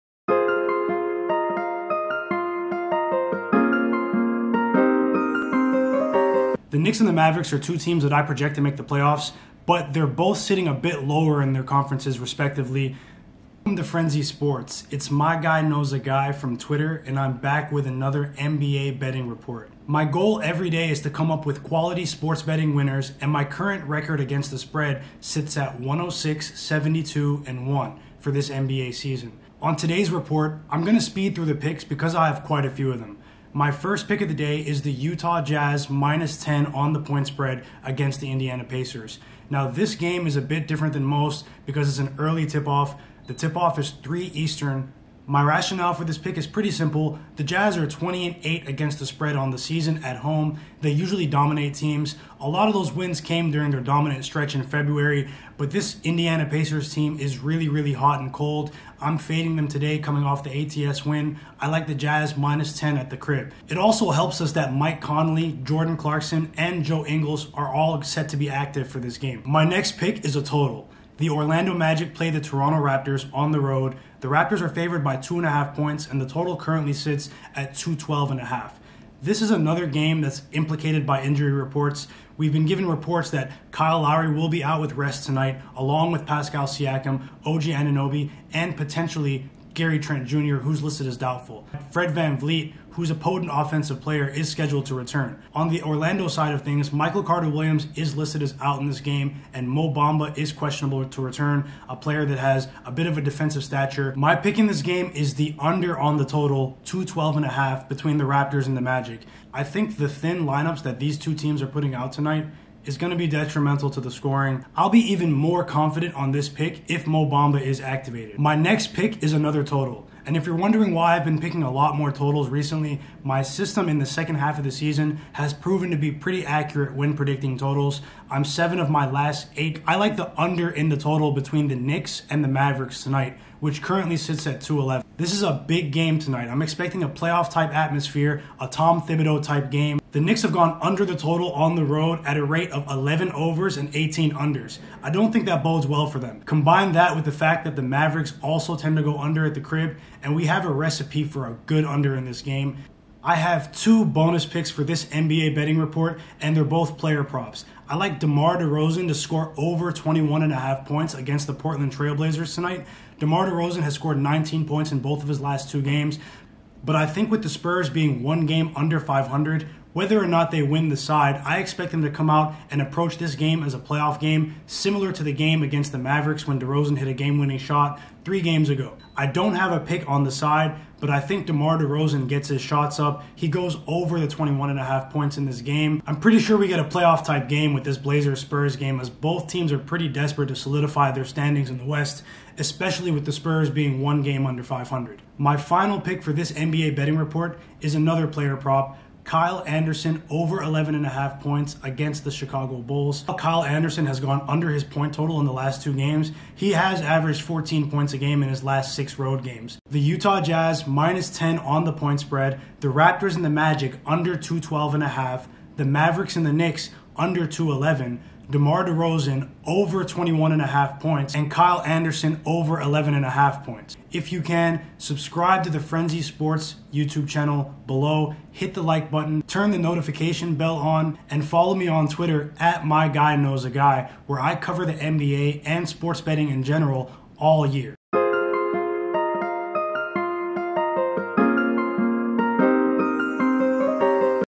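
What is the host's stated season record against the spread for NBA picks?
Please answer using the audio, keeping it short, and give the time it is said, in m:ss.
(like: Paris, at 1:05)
106-72-1, at 0:25.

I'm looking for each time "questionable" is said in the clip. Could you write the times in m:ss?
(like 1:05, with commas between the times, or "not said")
1:40.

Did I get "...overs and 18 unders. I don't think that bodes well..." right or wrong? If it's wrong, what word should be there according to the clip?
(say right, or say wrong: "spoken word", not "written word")
right.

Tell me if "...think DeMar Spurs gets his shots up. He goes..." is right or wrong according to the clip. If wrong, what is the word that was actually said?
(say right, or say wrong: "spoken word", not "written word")
wrong: "DeRozan", not "Spurs".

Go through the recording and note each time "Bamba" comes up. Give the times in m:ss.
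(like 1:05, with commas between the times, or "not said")
1:39, 1:57.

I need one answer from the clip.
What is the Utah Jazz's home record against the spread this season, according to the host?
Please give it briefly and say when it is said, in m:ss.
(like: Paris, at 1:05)
20-8, at 0:47.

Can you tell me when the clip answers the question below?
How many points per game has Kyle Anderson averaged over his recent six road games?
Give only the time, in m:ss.
3:27.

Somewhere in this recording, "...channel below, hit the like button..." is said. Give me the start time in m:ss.
3:47.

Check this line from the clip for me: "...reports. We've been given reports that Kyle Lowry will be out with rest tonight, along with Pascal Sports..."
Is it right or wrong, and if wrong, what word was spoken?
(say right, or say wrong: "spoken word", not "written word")
wrong: "Siakam", not "Sports".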